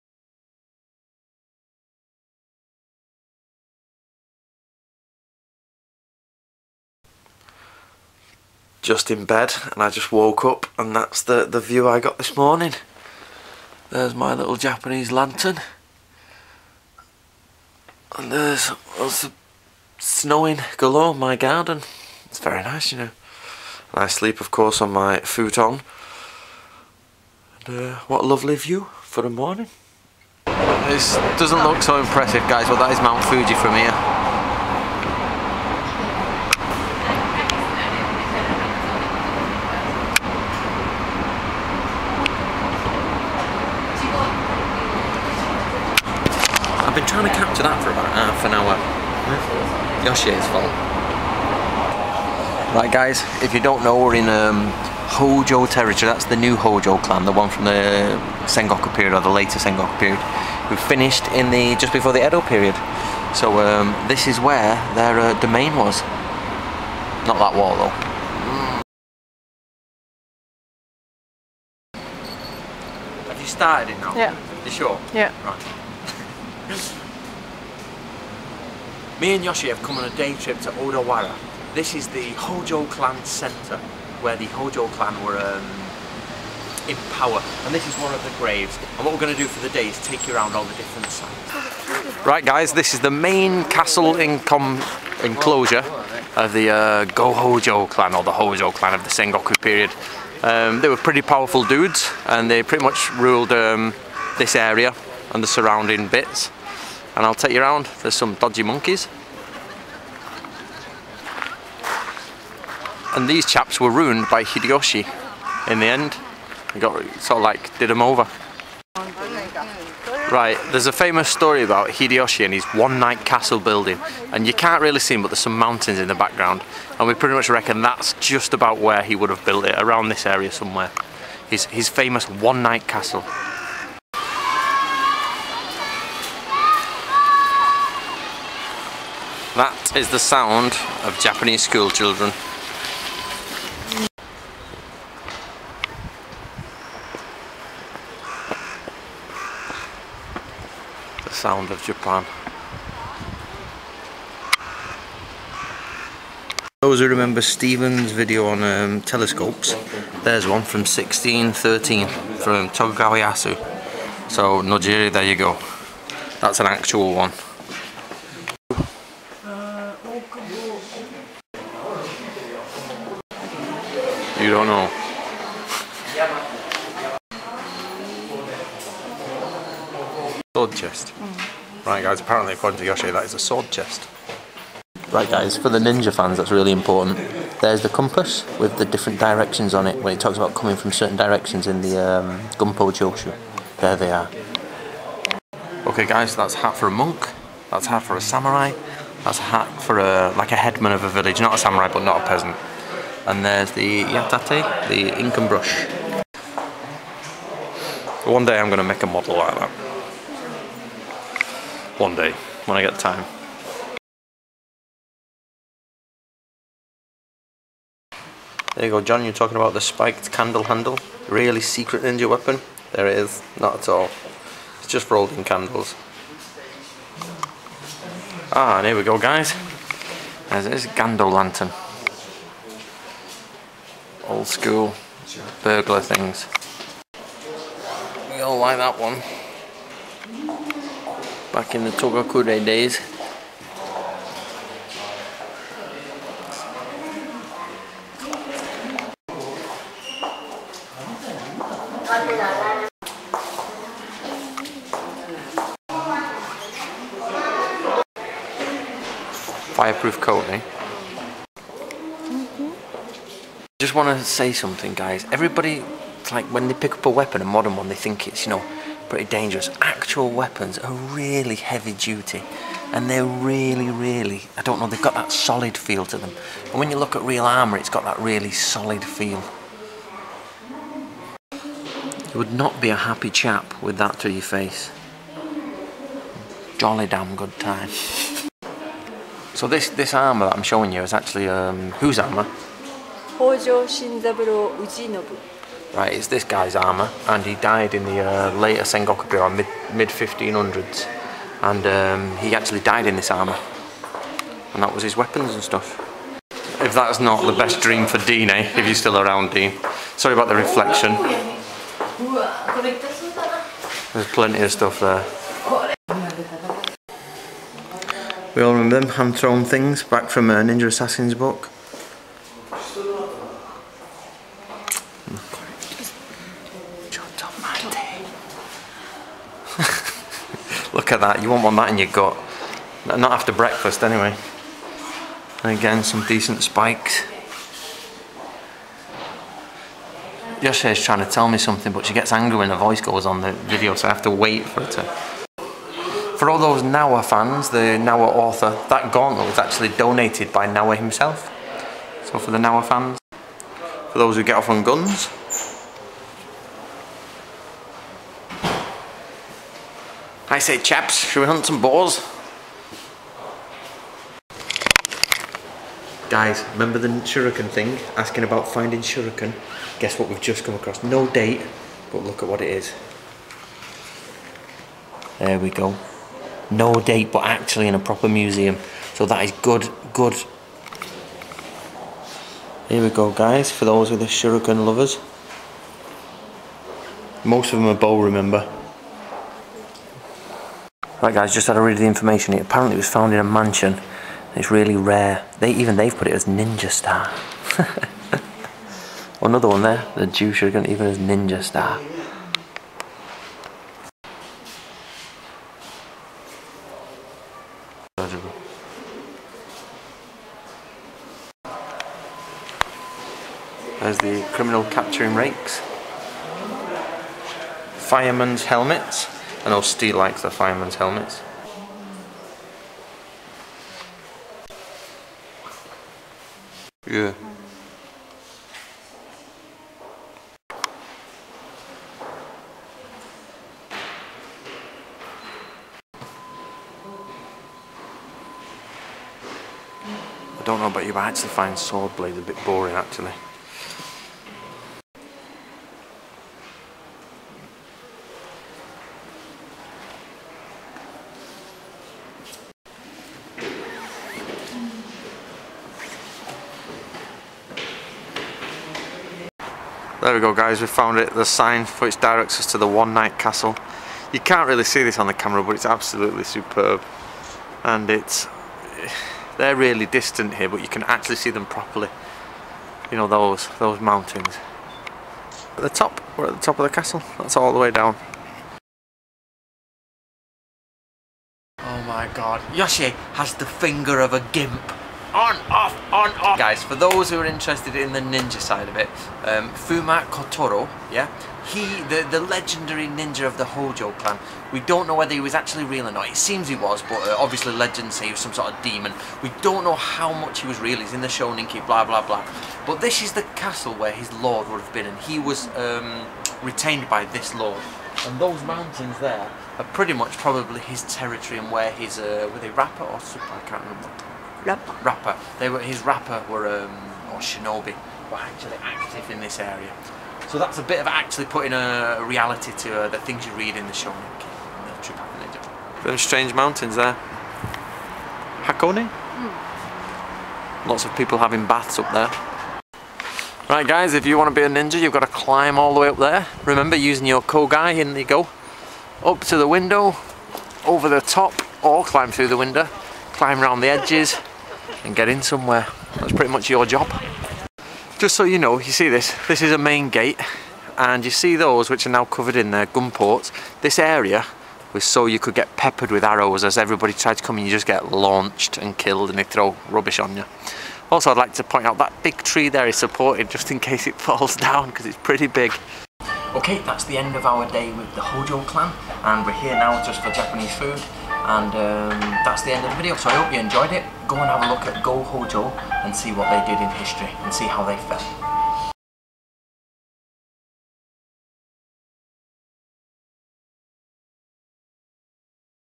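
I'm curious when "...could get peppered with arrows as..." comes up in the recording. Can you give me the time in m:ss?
9:15.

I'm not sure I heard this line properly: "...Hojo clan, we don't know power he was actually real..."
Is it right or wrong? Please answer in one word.
wrong.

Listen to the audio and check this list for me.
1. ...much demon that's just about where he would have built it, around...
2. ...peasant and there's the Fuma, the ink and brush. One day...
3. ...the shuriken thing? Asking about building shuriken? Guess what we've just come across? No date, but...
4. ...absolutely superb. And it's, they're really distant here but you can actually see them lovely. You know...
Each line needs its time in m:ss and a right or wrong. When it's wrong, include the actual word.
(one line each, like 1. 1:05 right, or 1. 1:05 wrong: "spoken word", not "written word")
1. 2:07 wrong: "reckon", not "demon"
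2. 3:22 wrong: "Yatate", not "Fuma"
3. 6:06 wrong: "finding", not "building"
4. 7:45 wrong: "properly", not "lovely".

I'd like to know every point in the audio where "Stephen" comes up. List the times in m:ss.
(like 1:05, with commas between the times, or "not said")
2:37.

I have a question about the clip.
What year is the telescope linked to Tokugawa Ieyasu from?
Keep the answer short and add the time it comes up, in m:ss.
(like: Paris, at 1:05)
1613, at 2:40.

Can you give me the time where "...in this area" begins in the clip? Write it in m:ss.
8:39.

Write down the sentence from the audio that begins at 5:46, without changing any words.
For all those Nawa fans, the Nawa author, that gauntlet was actually donated by Nawa himself.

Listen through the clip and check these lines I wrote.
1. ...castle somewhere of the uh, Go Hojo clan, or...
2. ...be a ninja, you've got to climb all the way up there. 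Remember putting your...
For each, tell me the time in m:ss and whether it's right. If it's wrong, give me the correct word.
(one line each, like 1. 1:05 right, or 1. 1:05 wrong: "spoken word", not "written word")
1. 1:33 wrong: "enclosure", not "somewhere"
2. 8:54 wrong: "using", not "putting".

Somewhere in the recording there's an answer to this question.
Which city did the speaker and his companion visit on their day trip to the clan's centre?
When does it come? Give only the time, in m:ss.
1:20.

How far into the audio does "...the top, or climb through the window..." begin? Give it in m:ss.
9:01.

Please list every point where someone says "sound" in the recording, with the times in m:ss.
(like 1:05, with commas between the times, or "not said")
2:20, 2:31.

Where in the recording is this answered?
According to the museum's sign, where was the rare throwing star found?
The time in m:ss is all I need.
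6:33.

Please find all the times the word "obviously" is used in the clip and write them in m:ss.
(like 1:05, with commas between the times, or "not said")
8:17.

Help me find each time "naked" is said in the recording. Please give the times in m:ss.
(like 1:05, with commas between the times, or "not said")
not said.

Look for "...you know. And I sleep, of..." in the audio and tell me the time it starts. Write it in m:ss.
0:22.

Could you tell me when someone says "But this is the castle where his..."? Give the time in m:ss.
8:22.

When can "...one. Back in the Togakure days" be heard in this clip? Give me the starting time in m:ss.
3:58.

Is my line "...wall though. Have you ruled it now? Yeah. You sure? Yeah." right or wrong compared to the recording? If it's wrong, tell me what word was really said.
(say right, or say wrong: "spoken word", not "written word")
wrong: "started", not "ruled".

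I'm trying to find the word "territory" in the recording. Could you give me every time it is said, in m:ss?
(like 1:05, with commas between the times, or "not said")
0:55, 8:31.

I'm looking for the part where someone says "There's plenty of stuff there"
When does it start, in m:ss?
5:14.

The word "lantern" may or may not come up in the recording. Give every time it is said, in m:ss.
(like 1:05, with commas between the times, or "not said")
0:15, 3:51.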